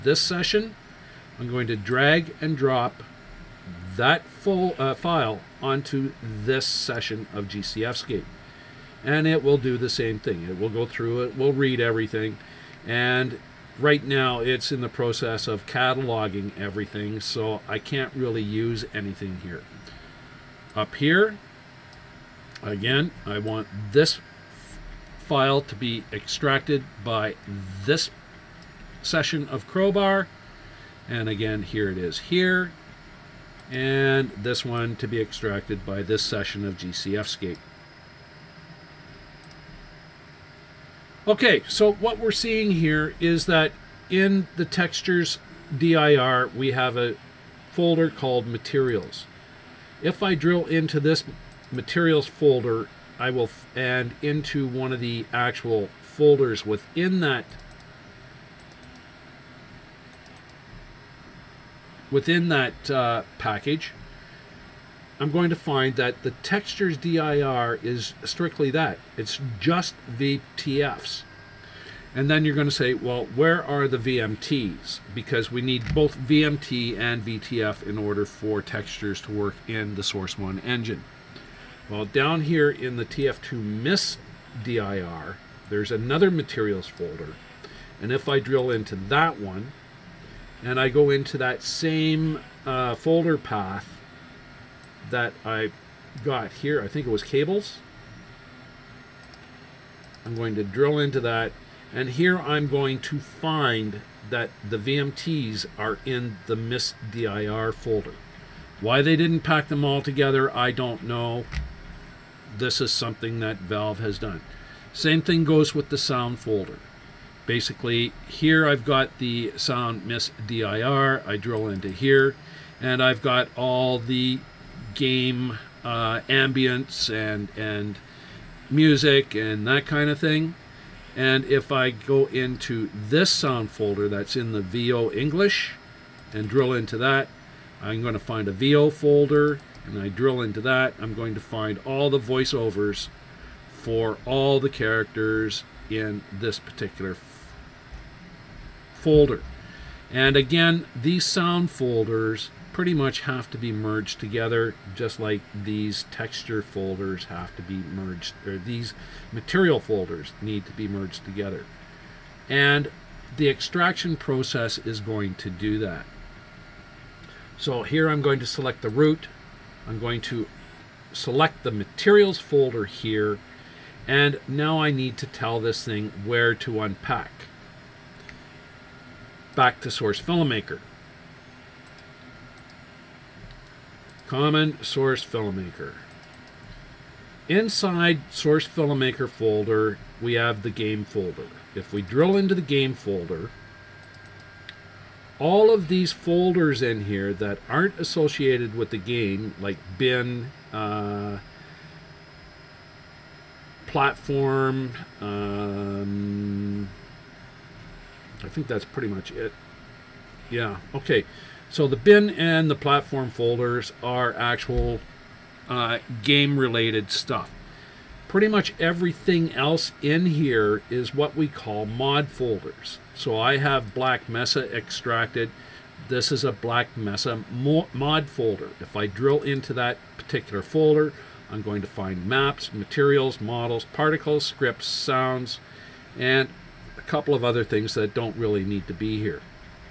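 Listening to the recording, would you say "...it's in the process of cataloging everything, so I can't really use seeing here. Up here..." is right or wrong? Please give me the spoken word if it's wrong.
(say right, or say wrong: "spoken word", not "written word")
wrong: "anything", not "seeing".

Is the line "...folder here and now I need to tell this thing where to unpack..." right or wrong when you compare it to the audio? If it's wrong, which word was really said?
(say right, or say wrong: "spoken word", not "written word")
right.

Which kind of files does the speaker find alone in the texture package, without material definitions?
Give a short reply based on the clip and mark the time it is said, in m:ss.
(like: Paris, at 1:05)
VTFs, at 1:09.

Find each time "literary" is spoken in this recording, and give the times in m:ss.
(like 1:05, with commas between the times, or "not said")
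not said.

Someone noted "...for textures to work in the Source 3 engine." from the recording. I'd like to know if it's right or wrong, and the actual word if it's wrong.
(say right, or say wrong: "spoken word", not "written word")
wrong: "1", not "3".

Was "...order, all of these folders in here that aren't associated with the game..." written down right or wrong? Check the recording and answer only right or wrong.
wrong.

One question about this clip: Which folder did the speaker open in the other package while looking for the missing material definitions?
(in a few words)
cables.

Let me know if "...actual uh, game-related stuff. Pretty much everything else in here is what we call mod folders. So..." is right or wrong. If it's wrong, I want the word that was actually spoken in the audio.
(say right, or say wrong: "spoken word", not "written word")
right.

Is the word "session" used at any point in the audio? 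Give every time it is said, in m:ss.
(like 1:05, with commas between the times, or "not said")
0:00, 0:06, 0:29, 0:36.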